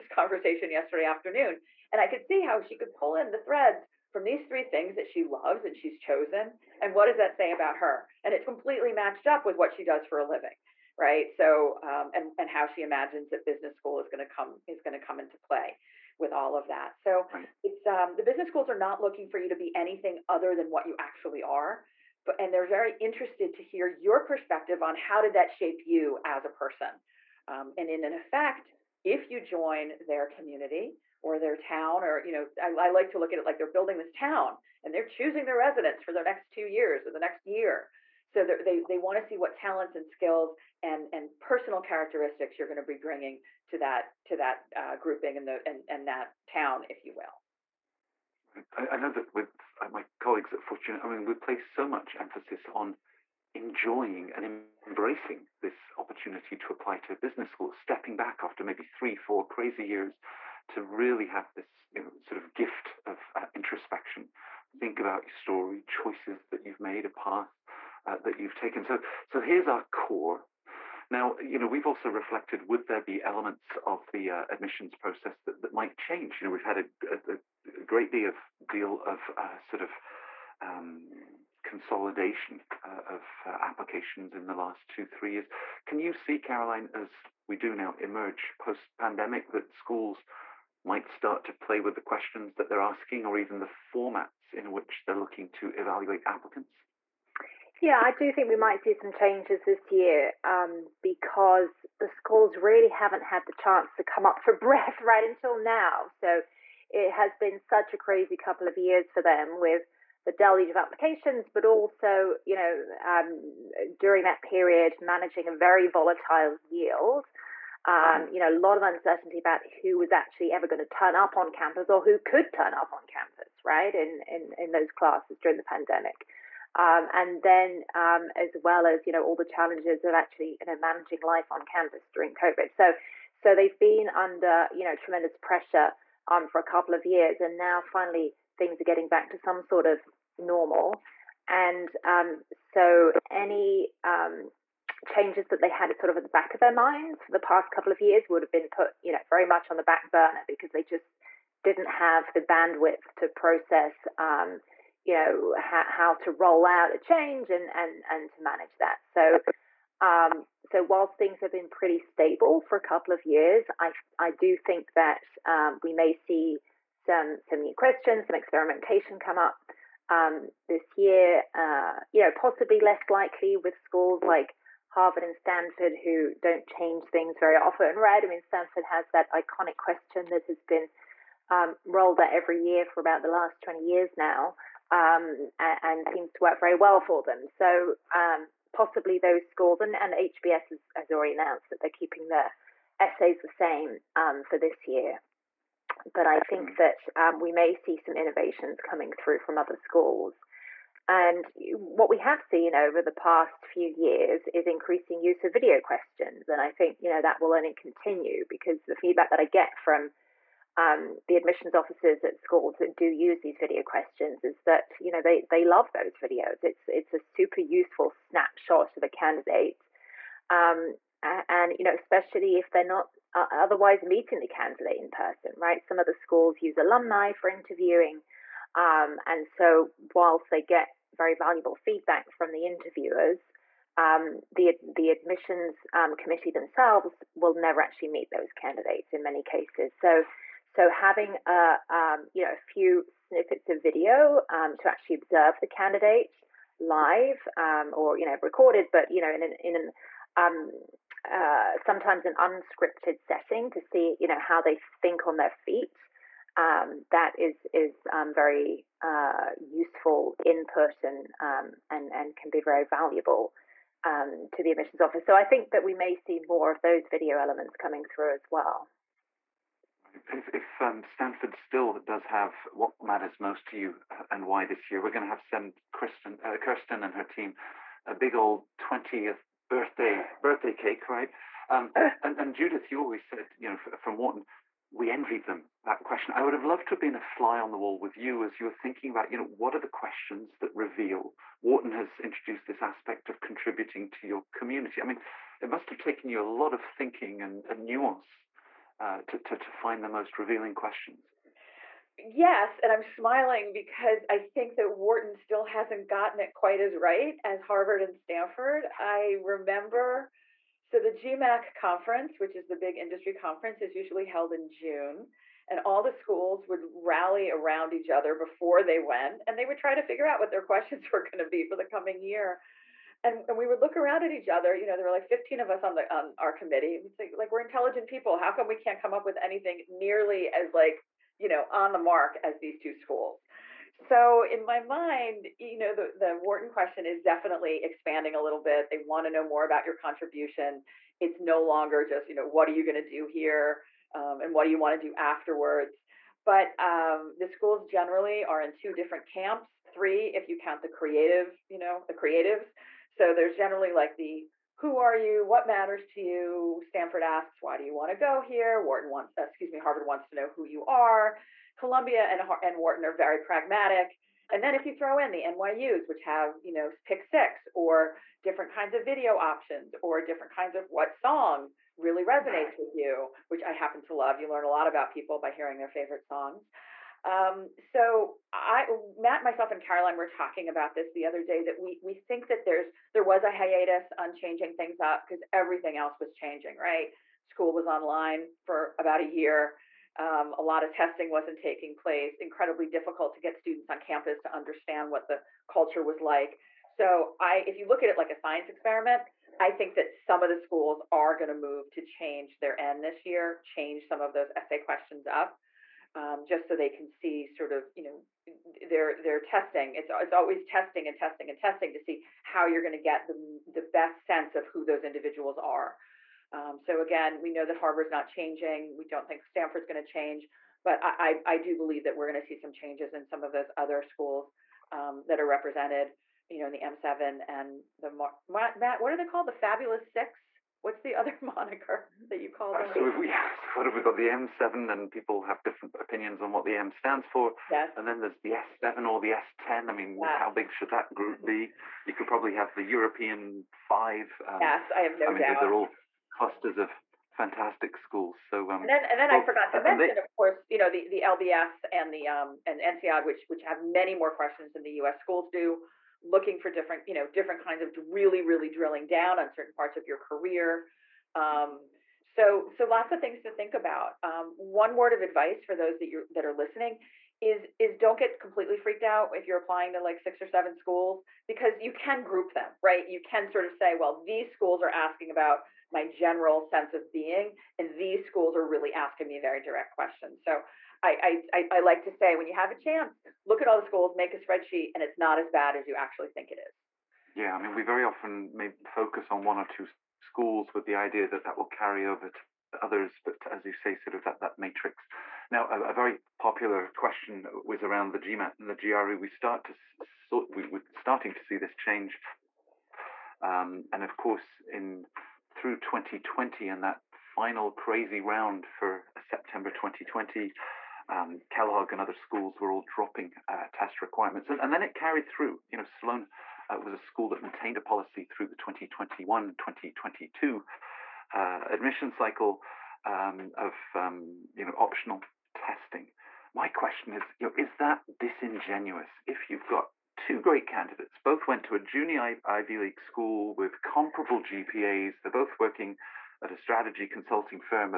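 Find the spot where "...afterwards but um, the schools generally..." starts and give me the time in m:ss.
5:45.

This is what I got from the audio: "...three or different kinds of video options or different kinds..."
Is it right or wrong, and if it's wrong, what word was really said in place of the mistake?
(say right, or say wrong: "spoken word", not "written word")
wrong: "six", not "three".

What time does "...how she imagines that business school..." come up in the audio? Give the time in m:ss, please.
0:12.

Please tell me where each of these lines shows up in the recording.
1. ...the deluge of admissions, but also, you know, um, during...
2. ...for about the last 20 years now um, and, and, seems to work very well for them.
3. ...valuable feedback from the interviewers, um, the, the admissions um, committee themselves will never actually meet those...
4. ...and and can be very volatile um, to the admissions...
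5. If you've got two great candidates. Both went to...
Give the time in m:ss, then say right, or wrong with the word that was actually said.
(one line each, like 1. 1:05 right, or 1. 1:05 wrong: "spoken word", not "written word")
1. 1:50 wrong: "applications", not "admissions"
2. 3:02 right
3. 3:51 right
4. 4:21 wrong: "valuable", not "volatile"
5. 8:49 right.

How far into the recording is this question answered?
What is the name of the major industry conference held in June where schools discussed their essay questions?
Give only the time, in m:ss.
5:11.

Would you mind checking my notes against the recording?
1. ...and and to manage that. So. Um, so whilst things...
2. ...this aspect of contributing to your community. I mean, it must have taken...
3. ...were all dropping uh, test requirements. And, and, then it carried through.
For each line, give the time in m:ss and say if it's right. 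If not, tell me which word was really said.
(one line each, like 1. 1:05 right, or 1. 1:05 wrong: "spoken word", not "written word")
1. 2:37 right
2. 4:52 right
3. 8:32 right.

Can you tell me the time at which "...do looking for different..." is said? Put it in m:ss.
7:35.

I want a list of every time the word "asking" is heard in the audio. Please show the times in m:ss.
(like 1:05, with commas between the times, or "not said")
1:32, 7:54, 7:58.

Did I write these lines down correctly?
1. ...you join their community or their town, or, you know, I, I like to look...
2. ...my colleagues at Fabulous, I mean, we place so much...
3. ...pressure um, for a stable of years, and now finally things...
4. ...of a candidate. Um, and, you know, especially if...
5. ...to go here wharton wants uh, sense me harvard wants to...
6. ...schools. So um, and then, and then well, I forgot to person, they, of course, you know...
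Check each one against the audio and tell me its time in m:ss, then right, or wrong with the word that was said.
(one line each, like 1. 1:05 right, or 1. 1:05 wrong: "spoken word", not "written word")
1. 0:29 right
2. 0:49 wrong: "Fortuna", not "Fabulous"
3. 2:15 wrong: "couple", not "stable"
4. 3:38 right
5. 5:58 wrong: "excuse", not "sense"
6. 7:27 wrong: "mention", not "person".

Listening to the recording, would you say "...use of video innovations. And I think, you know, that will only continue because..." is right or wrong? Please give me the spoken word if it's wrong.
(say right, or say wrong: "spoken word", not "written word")
wrong: "questions", not "innovations".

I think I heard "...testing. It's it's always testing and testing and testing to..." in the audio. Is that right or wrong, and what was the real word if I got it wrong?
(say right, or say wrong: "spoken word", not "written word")
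right.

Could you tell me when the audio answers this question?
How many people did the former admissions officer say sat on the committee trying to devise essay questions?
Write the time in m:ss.
5:25.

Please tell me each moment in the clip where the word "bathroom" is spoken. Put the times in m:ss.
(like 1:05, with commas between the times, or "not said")
not said.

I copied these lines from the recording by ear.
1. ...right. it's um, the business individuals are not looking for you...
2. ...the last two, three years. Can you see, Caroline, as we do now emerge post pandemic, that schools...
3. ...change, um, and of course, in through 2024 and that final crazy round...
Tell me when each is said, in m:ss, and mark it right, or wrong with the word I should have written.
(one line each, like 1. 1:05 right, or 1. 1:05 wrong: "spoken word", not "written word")
1. 0:17 wrong: "schools", not "individuals"
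2. 1:24 right
3. 8:21 wrong: "2020", not "2024".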